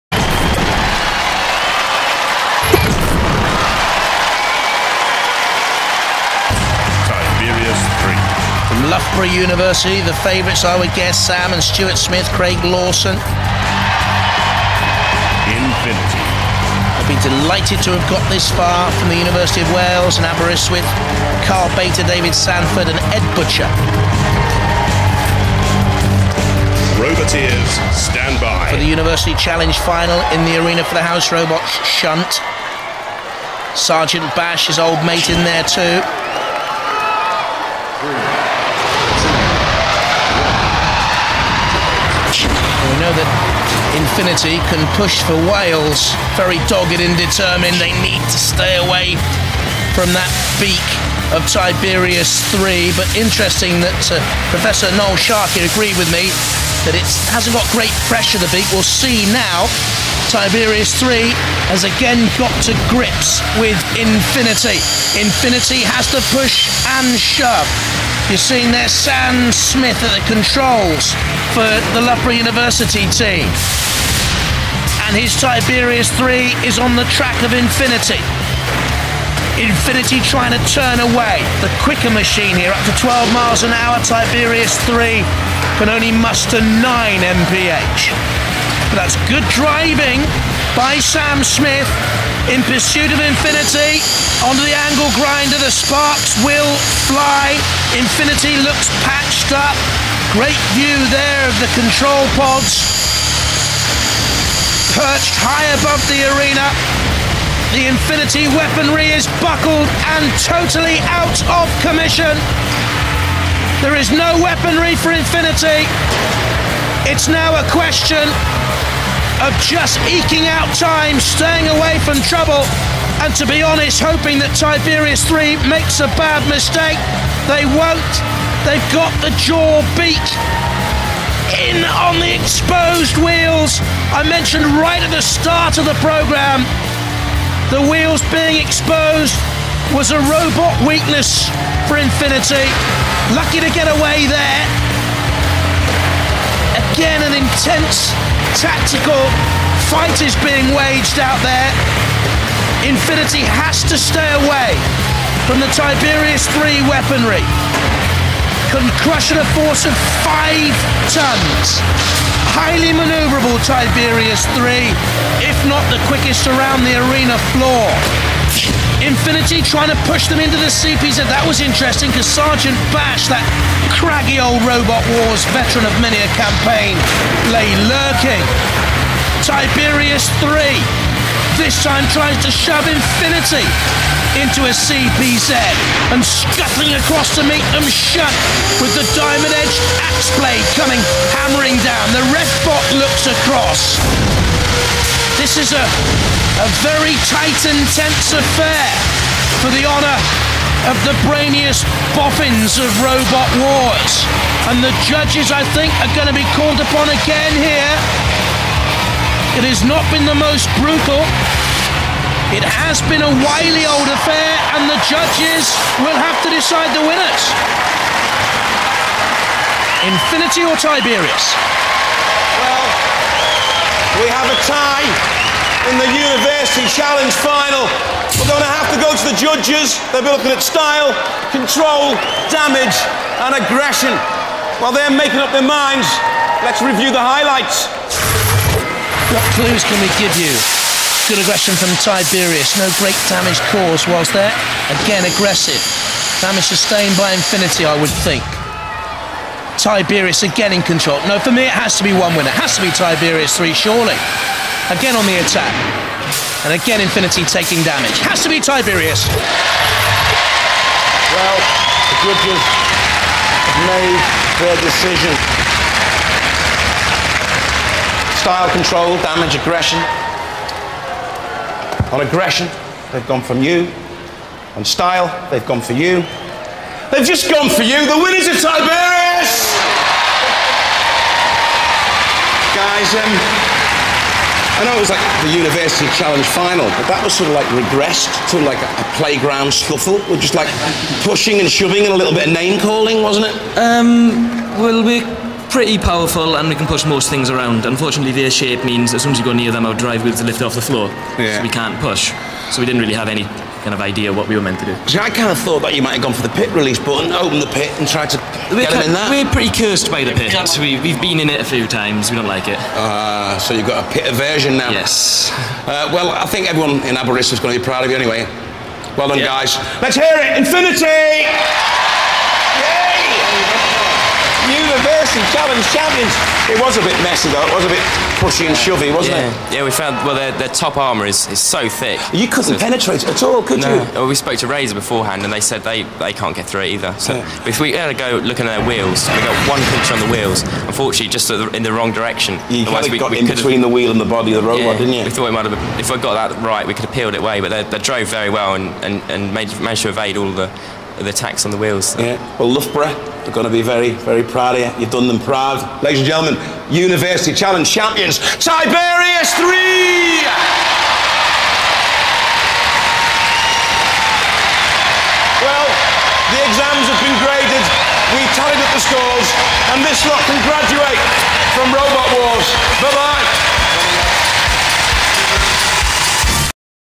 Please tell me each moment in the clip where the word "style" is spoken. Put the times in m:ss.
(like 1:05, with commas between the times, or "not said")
3:50, 4:28, 4:34.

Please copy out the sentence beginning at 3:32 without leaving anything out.
It has been a wily old affair, and the judges will have to decide the winners.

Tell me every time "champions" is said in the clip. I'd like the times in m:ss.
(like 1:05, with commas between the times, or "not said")
5:25, 5:57.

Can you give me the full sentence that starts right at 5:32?
You couldn't so penetrate it at all, could no.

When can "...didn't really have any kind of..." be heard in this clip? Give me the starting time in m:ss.
5:02.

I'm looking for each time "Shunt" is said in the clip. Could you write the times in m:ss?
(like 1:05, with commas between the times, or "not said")
0:31, 3:07.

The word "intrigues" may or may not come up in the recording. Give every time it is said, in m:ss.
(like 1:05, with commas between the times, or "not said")
not said.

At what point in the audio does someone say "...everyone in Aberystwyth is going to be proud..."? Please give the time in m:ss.
5:16.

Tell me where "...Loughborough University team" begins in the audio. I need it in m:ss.
1:12.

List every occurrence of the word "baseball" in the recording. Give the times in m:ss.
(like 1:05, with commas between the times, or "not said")
not said.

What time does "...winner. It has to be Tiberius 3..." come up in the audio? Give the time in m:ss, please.
4:12.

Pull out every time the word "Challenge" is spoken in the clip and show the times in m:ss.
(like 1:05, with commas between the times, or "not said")
0:29, 3:46, 4:46, 5:25, 5:57.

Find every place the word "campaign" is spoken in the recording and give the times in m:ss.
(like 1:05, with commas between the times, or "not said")
2:56.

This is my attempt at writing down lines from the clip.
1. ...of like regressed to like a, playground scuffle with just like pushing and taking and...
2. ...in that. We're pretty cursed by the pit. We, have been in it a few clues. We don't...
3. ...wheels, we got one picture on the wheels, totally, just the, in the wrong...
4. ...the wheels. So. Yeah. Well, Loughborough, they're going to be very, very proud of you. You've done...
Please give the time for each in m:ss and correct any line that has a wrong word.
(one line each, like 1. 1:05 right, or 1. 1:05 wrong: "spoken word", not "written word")
1. 4:47 wrong: "shoving", not "taking"
2. 5:09 wrong: "times", not "clues"
3. 5:38 wrong: "unfortunately", not "totally"
4. 5:51 right.